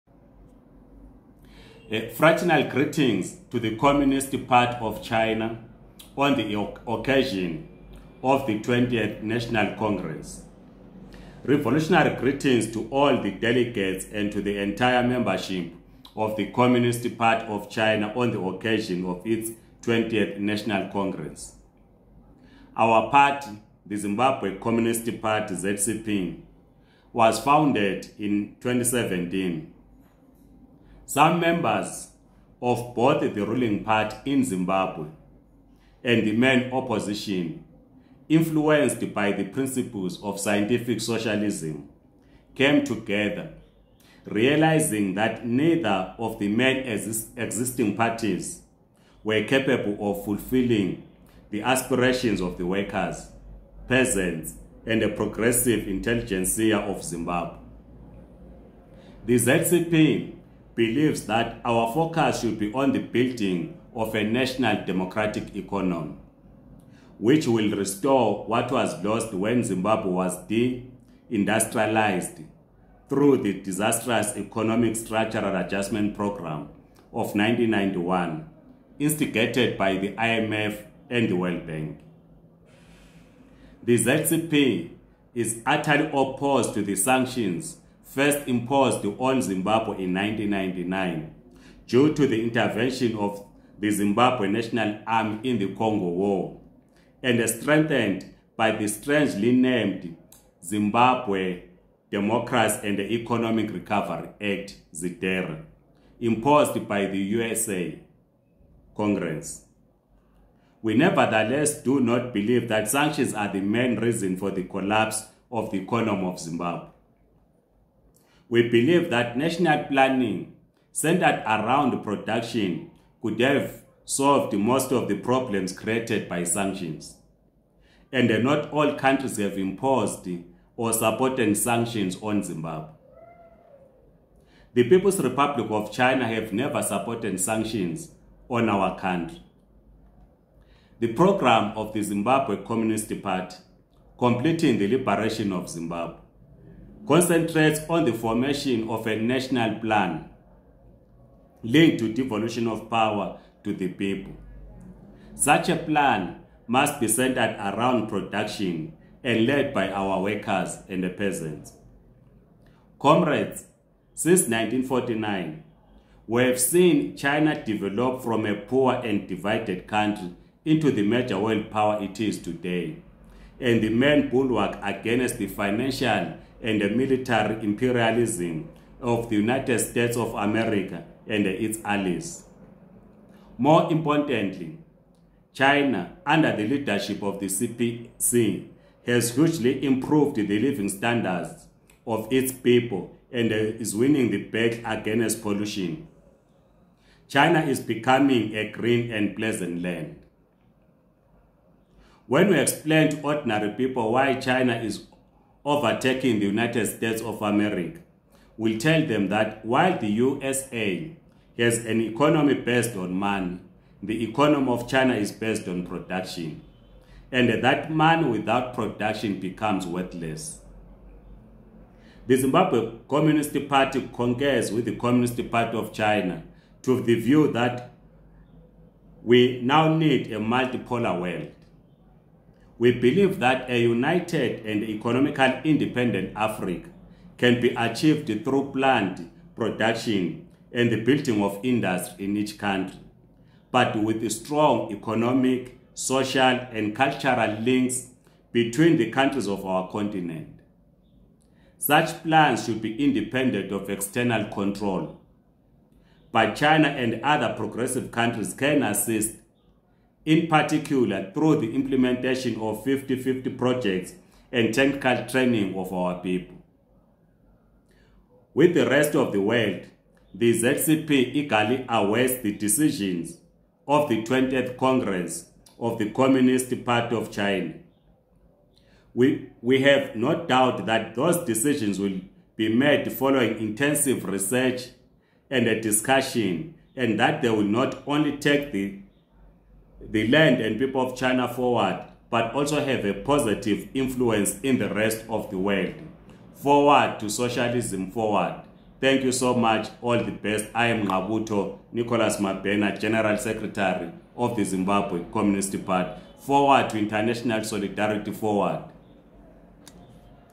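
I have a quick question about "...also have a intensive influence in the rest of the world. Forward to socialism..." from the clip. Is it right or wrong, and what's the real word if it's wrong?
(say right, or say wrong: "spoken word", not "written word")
wrong: "positive", not "intensive".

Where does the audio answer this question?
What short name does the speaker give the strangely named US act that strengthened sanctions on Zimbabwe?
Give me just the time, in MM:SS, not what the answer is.
01:44.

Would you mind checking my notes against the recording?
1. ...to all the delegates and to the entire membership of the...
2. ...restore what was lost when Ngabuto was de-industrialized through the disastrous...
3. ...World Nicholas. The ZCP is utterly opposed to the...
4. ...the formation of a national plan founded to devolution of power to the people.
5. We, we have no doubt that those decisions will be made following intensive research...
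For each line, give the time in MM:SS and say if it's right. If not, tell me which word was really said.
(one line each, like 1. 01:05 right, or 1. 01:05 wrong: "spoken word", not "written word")
1. 00:12 right
2. 01:07 wrong: "Zimbabwe", not "Ngabuto"
3. 01:21 wrong: "Bank", not "Nicholas"
4. 02:28 wrong: "linked", not "founded"
5. 04:39 right.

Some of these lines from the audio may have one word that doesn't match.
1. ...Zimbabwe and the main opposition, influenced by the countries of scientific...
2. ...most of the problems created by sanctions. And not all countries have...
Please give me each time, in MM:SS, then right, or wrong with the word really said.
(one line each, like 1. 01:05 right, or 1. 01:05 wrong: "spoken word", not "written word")
1. 00:34 wrong: "principles", not "countries"
2. 02:04 right.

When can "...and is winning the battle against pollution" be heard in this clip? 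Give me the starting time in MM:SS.
03:13.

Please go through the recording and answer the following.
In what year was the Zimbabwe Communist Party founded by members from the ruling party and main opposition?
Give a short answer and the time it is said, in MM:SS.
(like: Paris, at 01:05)
2017, at 00:28.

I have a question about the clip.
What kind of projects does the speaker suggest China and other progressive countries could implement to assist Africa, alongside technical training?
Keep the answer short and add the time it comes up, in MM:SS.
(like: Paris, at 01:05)
50-50 projects, at 04:22.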